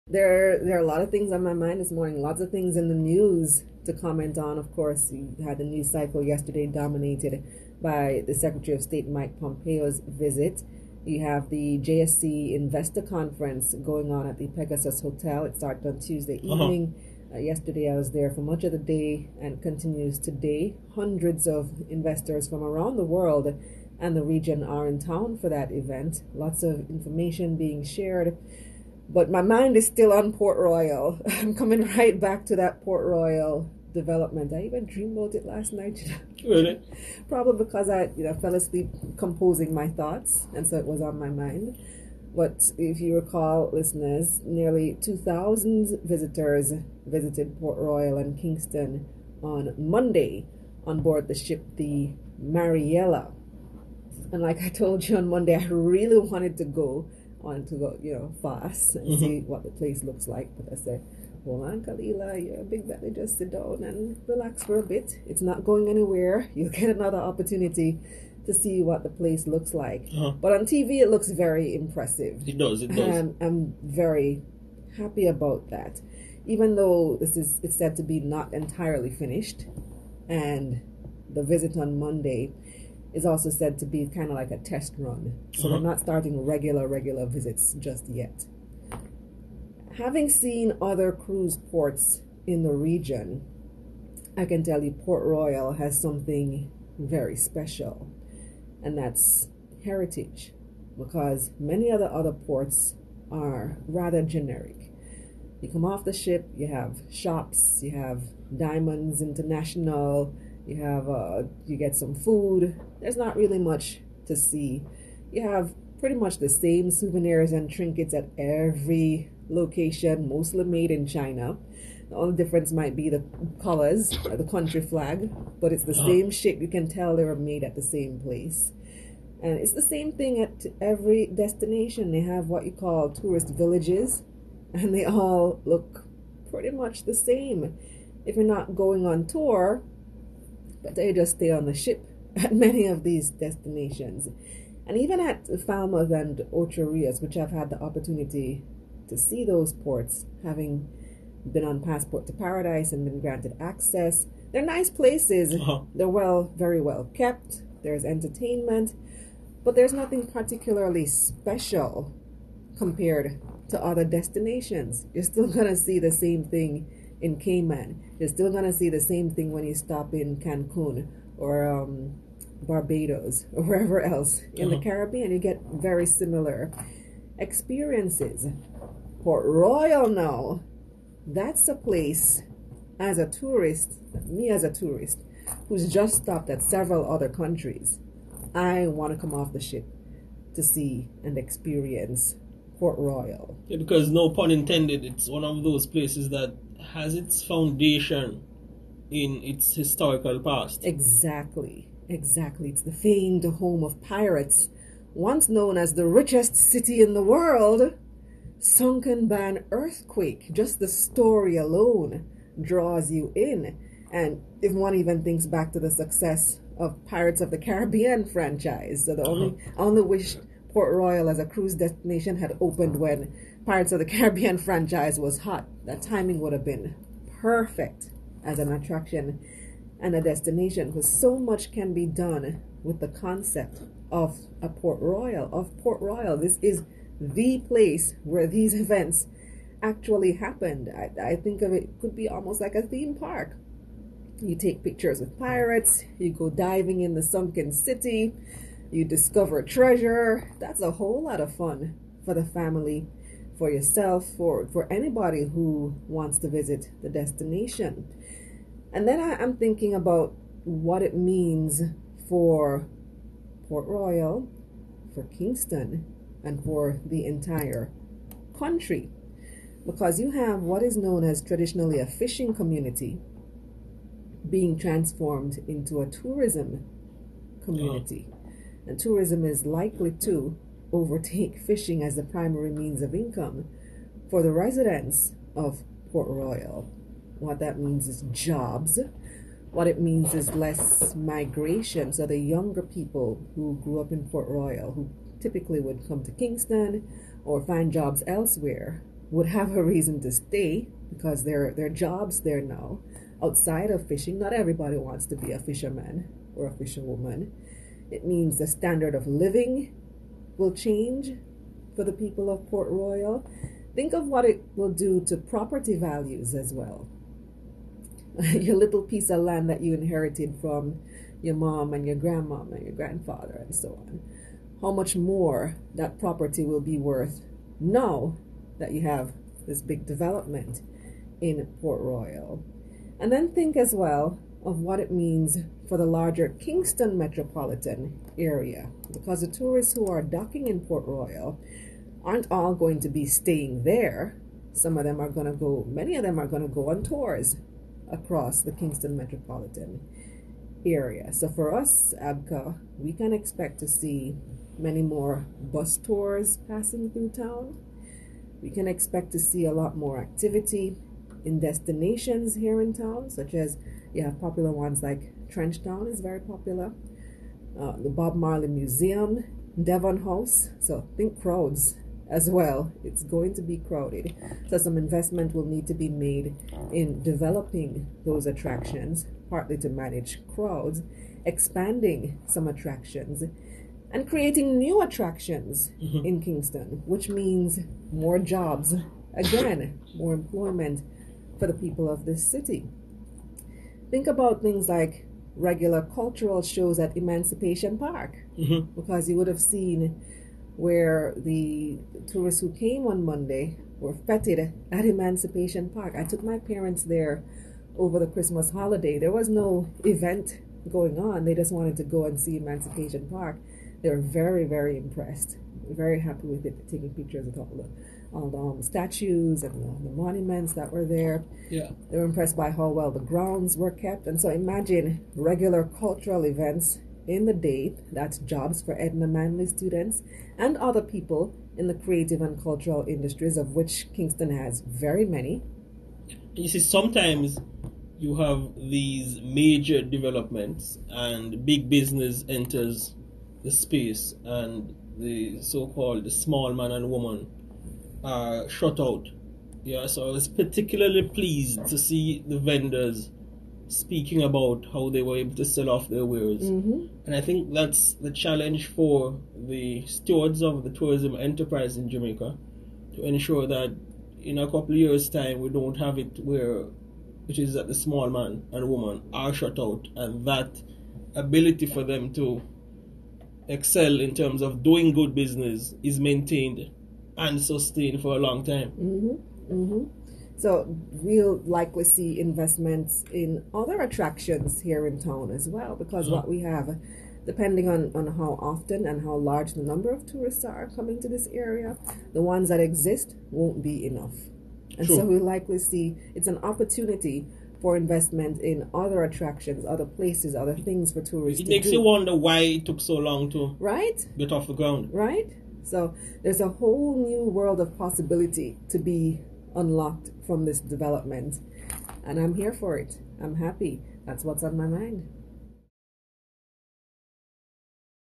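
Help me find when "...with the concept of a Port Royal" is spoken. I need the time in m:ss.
3:52.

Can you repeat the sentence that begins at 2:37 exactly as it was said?
There's entertainment, but there's nothing particularly special compared to other destinations.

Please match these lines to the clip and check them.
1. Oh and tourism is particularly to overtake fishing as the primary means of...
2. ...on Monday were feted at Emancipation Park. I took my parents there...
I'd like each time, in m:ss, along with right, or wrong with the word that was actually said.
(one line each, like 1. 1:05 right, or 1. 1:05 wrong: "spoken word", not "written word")
1. 4:38 wrong: "likely", not "particularly"
2. 6:43 right.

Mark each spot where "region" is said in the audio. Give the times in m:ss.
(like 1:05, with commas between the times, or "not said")
0:24, 1:32.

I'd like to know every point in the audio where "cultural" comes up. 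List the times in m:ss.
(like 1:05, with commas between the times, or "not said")
6:36, 7:05, 7:12.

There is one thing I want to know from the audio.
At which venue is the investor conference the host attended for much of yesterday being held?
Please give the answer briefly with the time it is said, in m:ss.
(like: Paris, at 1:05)
Pegasus Hotel, at 0:14.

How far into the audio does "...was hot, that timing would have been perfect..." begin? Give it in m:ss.
3:45.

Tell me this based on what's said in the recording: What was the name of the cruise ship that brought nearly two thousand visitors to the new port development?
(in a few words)
Marella.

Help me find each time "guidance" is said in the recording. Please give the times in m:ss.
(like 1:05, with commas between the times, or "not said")
not said.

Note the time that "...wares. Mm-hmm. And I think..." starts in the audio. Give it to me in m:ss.
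7:36.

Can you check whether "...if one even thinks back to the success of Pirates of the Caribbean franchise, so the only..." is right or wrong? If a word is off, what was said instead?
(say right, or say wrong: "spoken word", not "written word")
right.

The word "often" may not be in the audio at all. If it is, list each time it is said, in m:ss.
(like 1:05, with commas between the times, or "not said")
8:08.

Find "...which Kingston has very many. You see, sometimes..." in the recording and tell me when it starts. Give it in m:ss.
7:13.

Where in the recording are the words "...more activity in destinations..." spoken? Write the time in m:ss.
5:59.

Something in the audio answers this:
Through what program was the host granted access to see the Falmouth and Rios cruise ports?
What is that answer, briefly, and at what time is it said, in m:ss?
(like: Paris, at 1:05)
Passport to Paradise, at 2:31.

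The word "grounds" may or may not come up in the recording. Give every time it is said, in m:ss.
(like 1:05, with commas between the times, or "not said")
7:03, 8:24.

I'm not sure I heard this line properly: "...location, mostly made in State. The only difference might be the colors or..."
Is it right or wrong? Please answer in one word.
wrong.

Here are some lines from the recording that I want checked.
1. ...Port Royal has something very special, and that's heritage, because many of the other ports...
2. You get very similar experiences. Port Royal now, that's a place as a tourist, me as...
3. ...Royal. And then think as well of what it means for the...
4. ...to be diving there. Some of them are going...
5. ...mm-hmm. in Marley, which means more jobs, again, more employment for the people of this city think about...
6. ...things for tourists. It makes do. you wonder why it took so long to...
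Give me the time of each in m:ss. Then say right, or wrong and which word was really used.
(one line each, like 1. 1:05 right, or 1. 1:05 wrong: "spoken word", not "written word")
1. 1:34 right
2. 2:55 right
3. 5:32 right
4. 5:42 wrong: "staying", not "diving"
5. 6:26 wrong: "Kingston", not "Marley"
6. 8:20 right.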